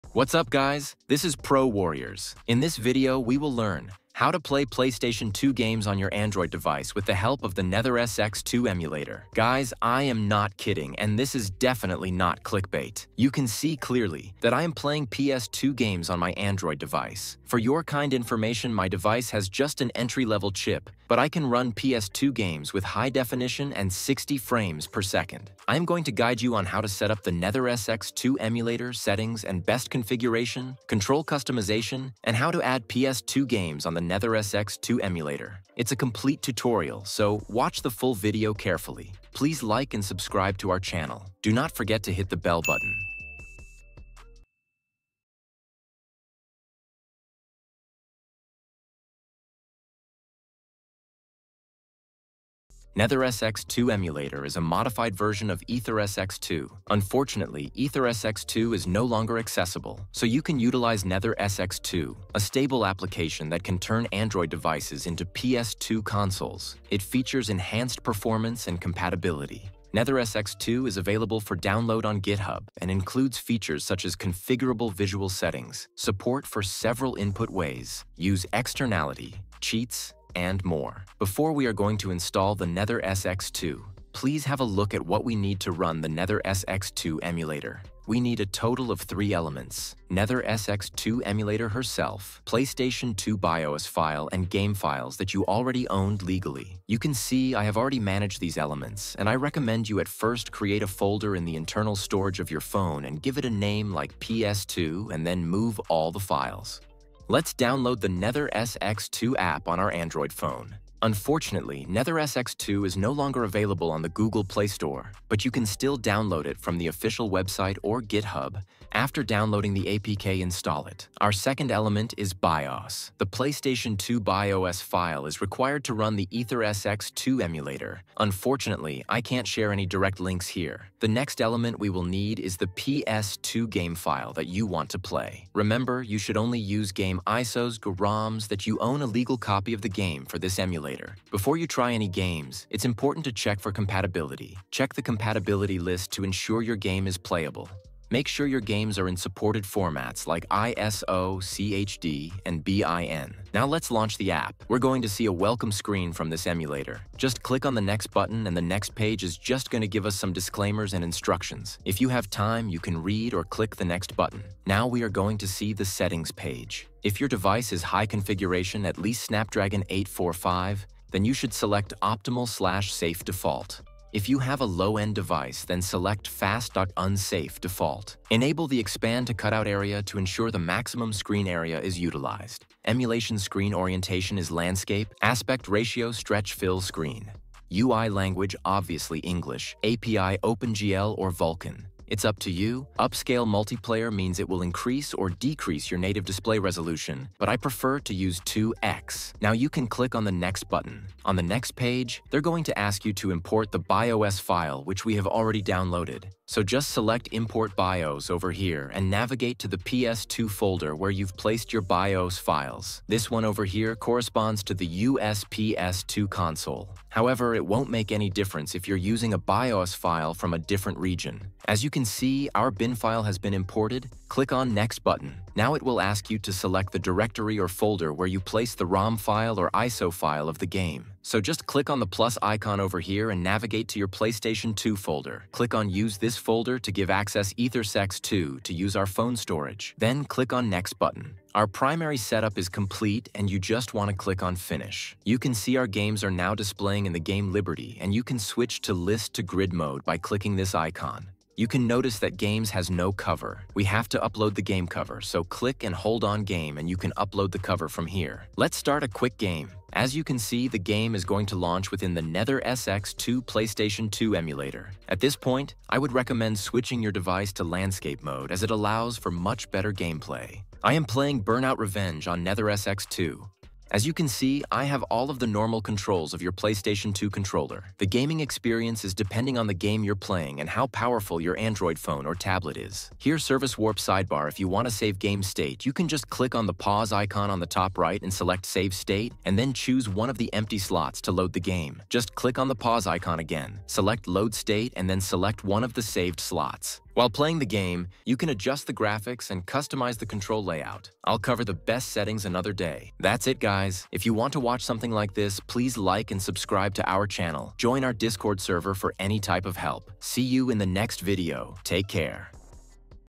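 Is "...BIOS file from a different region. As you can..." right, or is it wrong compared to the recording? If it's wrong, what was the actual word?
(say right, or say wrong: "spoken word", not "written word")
right.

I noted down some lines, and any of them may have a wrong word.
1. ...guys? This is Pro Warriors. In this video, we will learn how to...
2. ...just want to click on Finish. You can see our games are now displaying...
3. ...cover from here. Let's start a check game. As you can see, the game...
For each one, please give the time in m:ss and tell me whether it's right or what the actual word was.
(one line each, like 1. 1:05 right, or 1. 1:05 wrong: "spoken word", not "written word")
1. 0:00 right
2. 4:03 right
3. 4:17 wrong: "quick", not "check".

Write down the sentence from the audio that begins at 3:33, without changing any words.
This one over here corresponds to the USPS2 console.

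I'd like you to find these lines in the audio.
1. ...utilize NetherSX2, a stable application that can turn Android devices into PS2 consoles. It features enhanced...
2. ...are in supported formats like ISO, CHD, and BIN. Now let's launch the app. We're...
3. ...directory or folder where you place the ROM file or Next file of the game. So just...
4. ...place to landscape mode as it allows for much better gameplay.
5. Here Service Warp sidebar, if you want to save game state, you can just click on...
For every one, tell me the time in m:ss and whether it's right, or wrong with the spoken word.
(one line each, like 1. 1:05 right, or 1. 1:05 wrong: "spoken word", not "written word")
1. 1:00 right
2. 2:28 right
3. 3:47 wrong: "ISO", not "Next"
4. 4:27 wrong: "device", not "place"
5. 4:43 right.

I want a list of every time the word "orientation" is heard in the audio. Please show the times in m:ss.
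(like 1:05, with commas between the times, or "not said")
3:03.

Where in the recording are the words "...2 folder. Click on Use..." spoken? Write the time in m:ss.
3:54.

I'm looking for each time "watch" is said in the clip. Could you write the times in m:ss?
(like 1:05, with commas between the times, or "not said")
0:37, 5:04.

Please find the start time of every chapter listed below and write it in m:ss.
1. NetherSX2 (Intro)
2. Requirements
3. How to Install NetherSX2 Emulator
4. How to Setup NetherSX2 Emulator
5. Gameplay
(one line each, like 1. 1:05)
1. 0:52
2. 1:24
3. 1:58
4. 2:34
5. 4:19.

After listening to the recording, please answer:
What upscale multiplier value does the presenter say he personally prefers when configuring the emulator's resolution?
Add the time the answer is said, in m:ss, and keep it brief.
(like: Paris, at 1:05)
2x, at 3:18.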